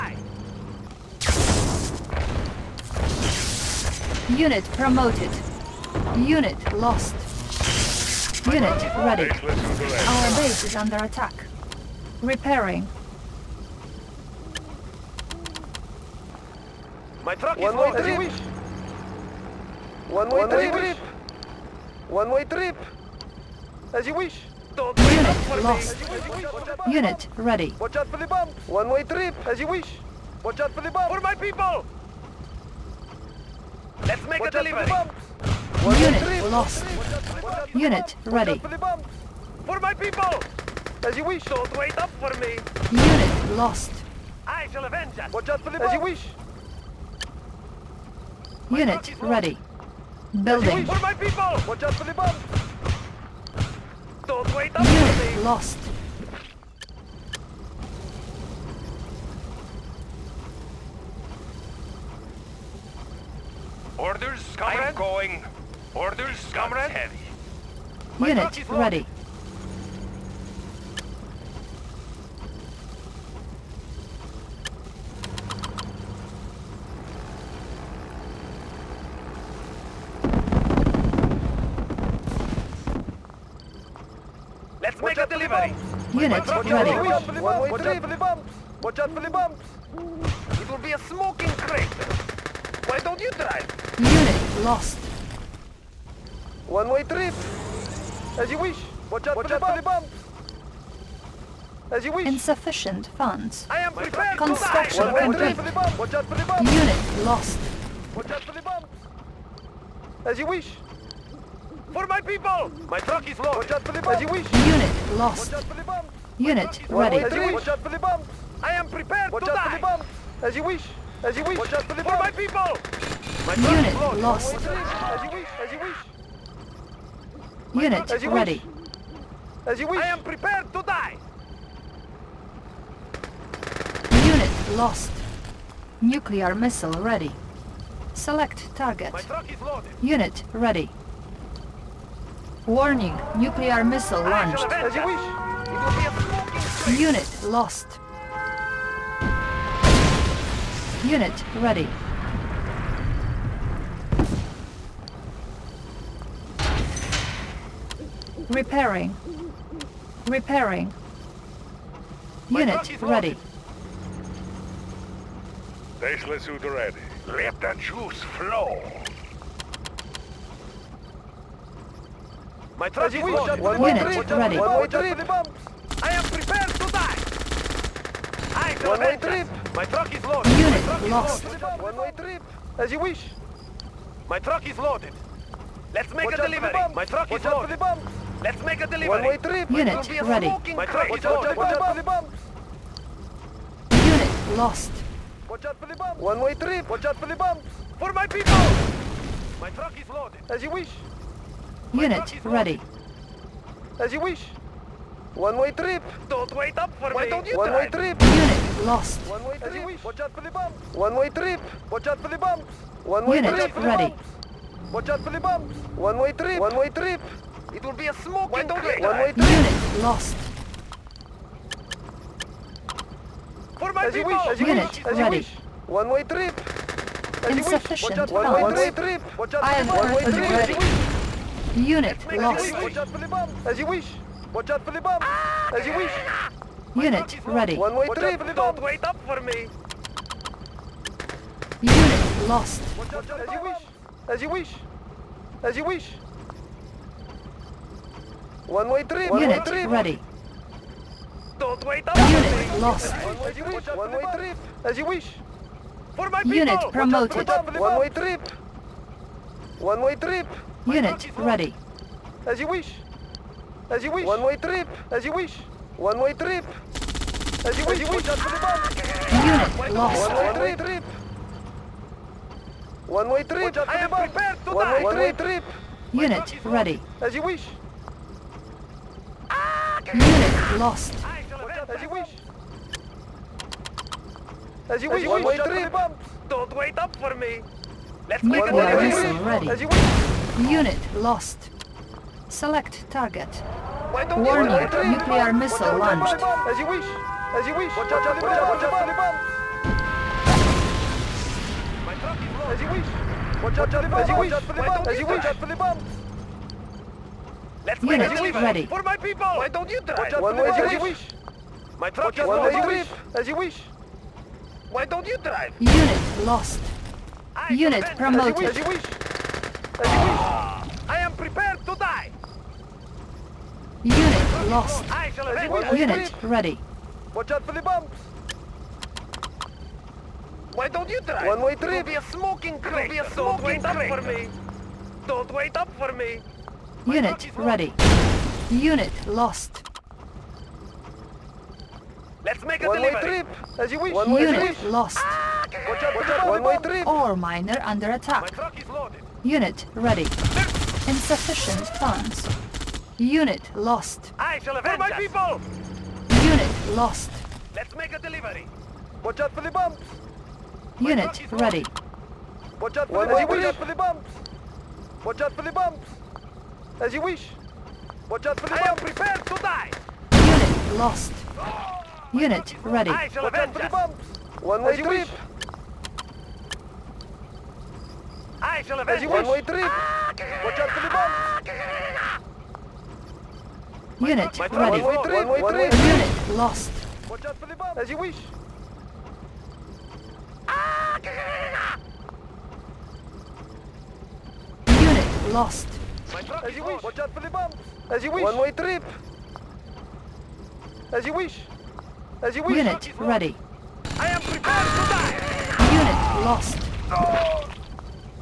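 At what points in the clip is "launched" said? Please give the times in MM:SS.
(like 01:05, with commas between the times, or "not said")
02:24, 04:55.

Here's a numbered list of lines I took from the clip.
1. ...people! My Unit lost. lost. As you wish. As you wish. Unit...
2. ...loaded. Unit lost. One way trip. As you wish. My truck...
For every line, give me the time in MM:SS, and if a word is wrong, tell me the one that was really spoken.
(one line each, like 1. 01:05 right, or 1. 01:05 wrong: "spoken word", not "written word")
1. 02:02 right
2. 03:00 right.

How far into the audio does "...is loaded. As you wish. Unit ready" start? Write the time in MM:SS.
03:20.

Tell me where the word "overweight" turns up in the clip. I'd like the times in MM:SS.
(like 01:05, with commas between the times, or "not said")
not said.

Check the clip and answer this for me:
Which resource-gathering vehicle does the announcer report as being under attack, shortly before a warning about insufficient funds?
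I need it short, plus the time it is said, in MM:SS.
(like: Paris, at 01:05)
Ore miner, at 05:47.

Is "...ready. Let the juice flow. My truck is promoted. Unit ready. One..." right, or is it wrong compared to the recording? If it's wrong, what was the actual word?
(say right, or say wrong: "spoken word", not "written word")
wrong: "loaded", not "promoted".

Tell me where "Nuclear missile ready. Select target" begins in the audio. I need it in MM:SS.
02:16.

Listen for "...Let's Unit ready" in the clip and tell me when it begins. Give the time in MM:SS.
05:07.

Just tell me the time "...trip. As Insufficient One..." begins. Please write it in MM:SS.
03:46.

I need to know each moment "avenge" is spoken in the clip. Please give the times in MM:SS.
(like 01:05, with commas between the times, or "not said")
00:44, 05:54, 06:18.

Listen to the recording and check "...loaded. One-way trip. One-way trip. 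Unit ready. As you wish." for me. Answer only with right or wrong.
wrong.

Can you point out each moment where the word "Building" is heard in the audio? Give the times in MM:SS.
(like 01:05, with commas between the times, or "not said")
00:50.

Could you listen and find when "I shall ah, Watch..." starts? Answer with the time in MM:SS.
06:13.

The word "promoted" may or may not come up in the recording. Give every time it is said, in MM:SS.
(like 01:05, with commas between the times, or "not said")
00:04, 04:16, 05:18.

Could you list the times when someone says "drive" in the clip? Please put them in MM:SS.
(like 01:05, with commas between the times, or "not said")
01:33, 05:10, 05:15, 05:31.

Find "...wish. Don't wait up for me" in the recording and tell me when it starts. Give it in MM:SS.
04:45.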